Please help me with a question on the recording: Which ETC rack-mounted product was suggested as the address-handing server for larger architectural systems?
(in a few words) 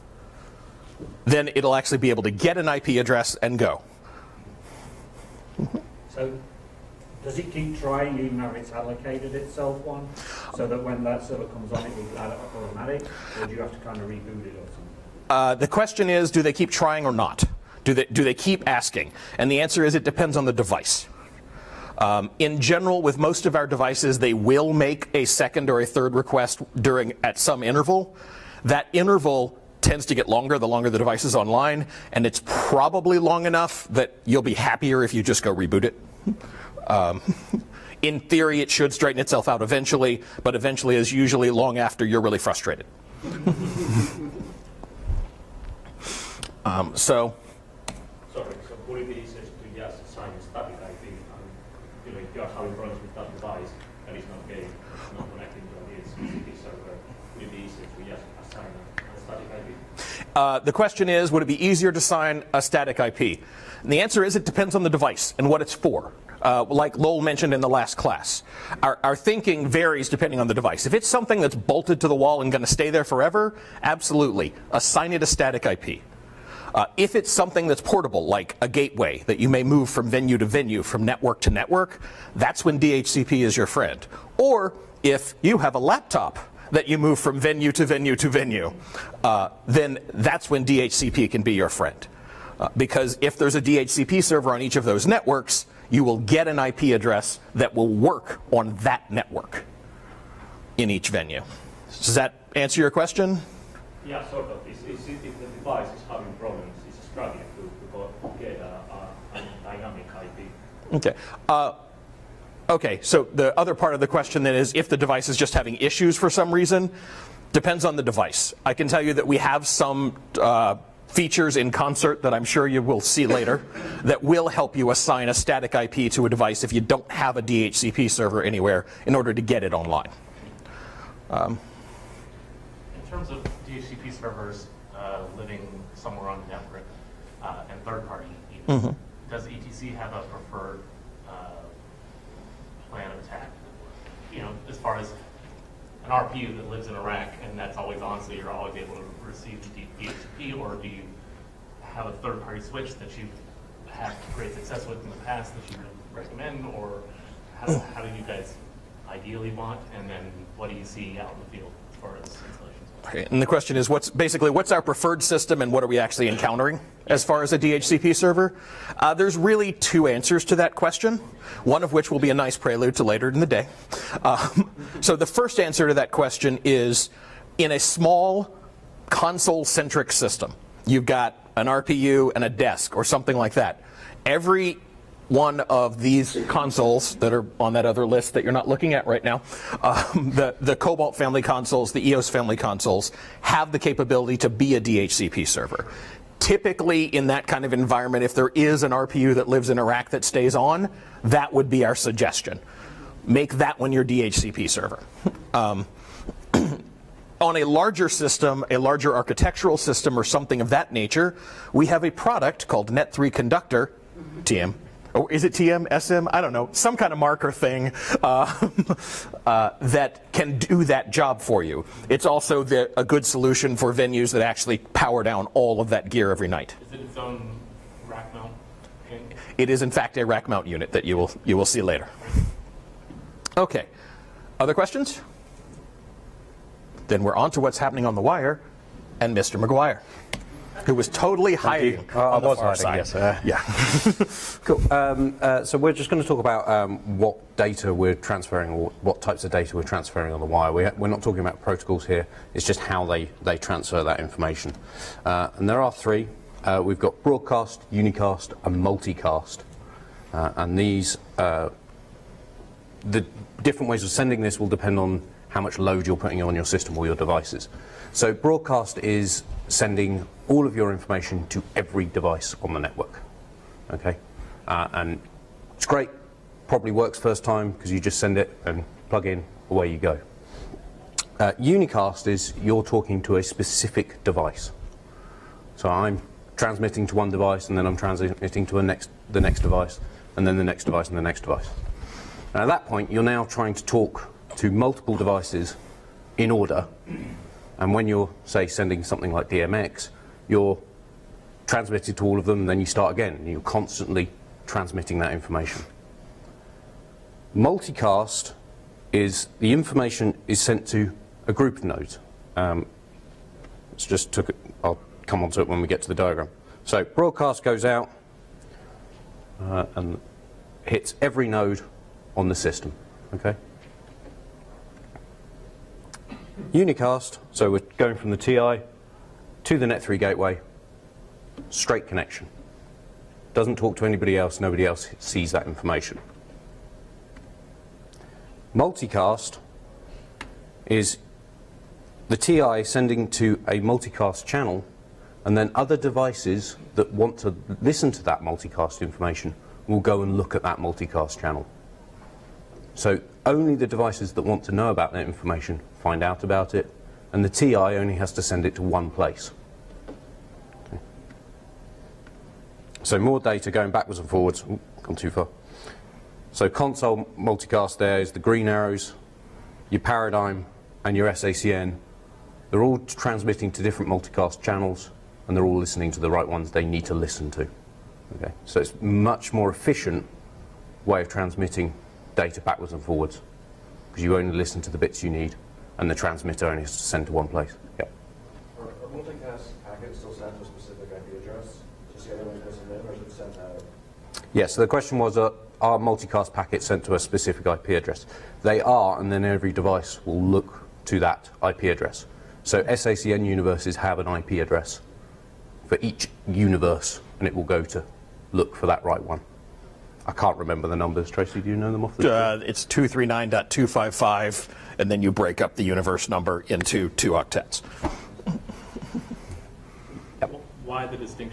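Net3 Conductor.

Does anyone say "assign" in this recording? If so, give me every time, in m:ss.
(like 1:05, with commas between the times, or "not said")
0:50, 0:58, 1:14, 2:04.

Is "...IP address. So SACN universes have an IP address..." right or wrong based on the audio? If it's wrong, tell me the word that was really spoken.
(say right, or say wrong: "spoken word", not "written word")
right.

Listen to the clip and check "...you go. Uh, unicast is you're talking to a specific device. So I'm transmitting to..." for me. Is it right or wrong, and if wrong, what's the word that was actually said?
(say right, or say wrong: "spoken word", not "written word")
right.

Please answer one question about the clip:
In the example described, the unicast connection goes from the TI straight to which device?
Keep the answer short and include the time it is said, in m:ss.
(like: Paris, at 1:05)
Net3 gateway, at 5:29.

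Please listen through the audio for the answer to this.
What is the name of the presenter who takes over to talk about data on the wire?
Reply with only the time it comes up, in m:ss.
3:59.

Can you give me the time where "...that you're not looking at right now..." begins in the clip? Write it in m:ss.
3:08.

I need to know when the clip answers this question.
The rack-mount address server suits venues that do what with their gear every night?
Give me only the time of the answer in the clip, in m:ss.
3:44.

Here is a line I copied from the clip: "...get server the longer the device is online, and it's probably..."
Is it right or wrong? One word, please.
wrong.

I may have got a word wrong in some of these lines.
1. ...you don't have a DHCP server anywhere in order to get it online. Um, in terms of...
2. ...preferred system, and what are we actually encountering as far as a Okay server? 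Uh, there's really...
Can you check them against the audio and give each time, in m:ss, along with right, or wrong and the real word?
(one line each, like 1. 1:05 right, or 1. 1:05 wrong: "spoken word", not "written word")
1. 2:06 right
2. 2:44 wrong: "DHCP", not "Okay".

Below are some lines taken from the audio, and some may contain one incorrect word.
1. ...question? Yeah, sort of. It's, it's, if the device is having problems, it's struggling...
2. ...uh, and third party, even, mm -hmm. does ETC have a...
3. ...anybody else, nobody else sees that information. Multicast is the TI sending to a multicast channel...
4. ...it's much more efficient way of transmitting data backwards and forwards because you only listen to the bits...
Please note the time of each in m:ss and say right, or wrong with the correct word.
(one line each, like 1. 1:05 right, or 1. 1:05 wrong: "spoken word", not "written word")
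1. 1:42 right
2. 2:17 right
3. 5:34 right
4. 6:18 right.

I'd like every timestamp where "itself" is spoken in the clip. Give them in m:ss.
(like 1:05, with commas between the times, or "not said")
0:09, 0:39.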